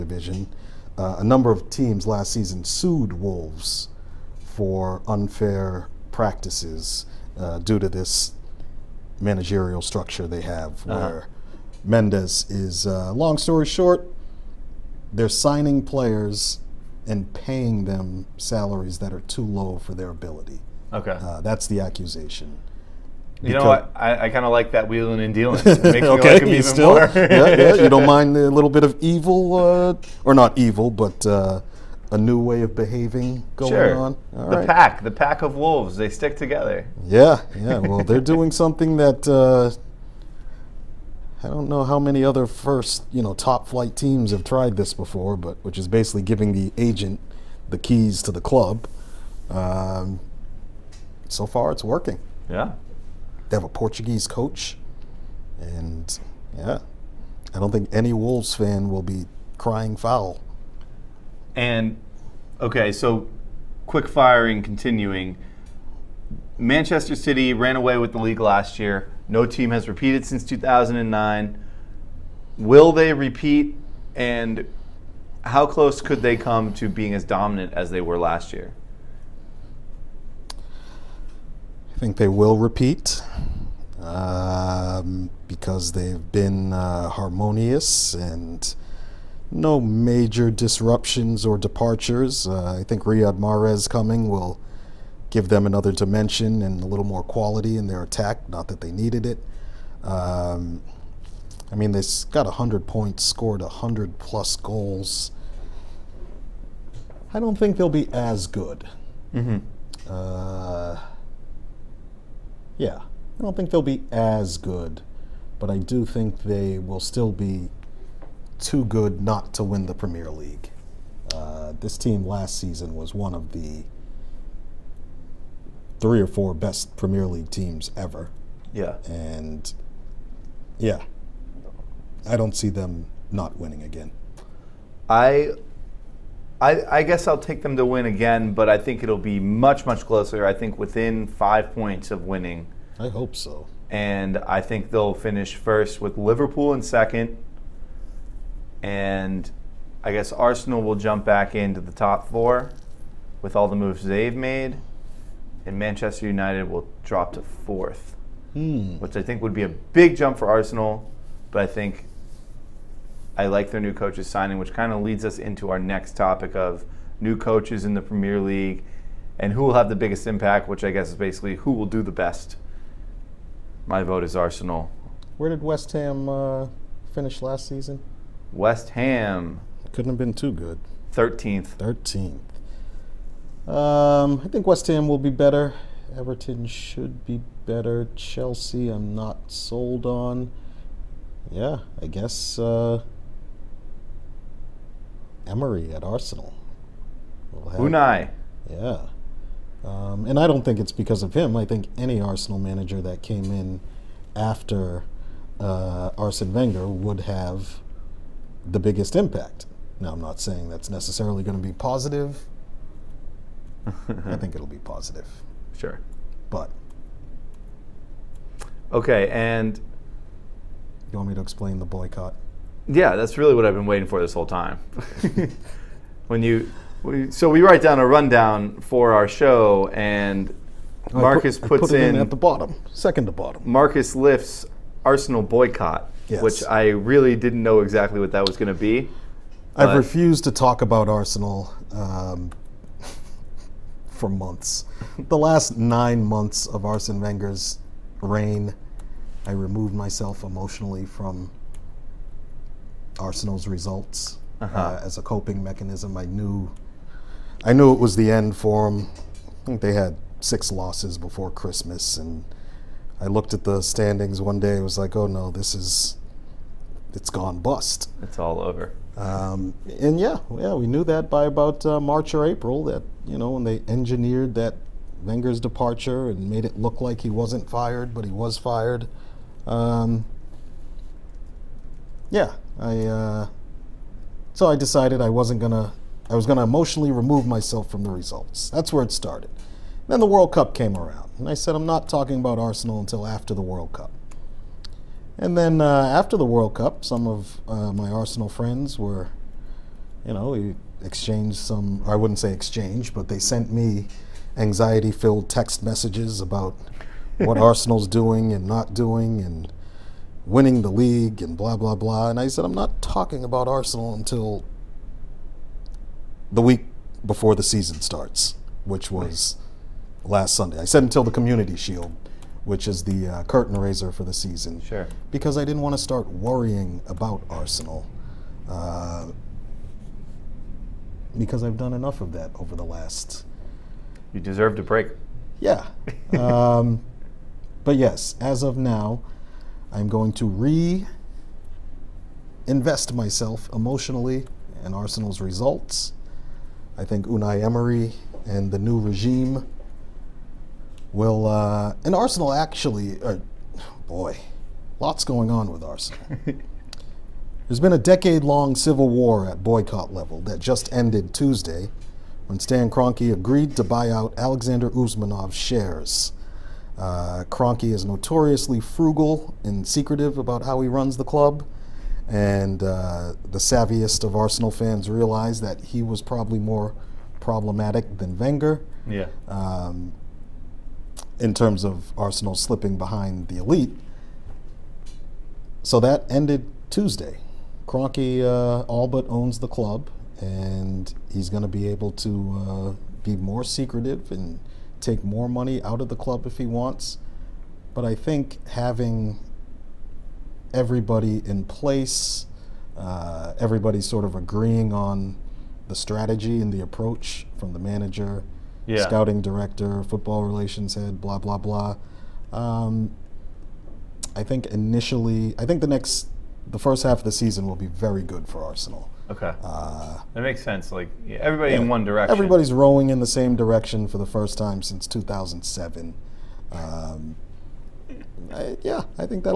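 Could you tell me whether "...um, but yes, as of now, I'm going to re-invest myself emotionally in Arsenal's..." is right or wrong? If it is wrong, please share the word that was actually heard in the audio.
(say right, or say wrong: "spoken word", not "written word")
right.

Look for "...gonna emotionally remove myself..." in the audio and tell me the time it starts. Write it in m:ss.
4:46.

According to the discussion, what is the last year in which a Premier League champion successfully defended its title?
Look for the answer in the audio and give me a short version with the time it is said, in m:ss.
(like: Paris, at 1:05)
2009, at 1:10.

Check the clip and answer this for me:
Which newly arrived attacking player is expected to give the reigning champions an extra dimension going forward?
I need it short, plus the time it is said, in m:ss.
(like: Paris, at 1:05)
Riyad Mahrez, at 1:33.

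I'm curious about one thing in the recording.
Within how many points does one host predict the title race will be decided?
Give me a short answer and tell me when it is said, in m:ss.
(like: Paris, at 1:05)
5, at 2:21.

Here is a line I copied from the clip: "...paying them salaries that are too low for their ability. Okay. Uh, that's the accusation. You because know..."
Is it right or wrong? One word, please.
right.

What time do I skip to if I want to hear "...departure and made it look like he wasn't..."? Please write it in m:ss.
4:35.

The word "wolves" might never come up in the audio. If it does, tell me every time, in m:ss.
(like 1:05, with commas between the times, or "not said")
0:03, 0:35, 0:58.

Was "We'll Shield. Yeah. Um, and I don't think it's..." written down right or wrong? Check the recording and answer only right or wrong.
wrong.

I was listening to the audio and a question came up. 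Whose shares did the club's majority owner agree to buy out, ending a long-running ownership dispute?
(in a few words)
Alexander Usmanov.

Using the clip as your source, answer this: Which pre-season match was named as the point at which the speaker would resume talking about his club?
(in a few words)
Community Shield.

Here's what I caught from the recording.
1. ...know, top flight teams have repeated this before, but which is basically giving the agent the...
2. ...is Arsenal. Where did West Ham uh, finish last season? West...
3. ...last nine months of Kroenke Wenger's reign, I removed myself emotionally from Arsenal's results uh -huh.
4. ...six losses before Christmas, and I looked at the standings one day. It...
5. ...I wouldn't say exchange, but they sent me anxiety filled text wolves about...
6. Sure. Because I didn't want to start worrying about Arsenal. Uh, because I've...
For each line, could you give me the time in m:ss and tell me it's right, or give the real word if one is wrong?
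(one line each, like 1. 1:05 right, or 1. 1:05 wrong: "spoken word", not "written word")
1. 0:43 wrong: "tried", not "repeated"
2. 2:54 right
3. 4:05 wrong: "Arsene", not "Kroenke"
4. 4:20 right
5. 5:02 wrong: "messages", not "wolves"
6. 5:24 right.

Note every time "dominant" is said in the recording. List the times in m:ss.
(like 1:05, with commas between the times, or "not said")
1:17.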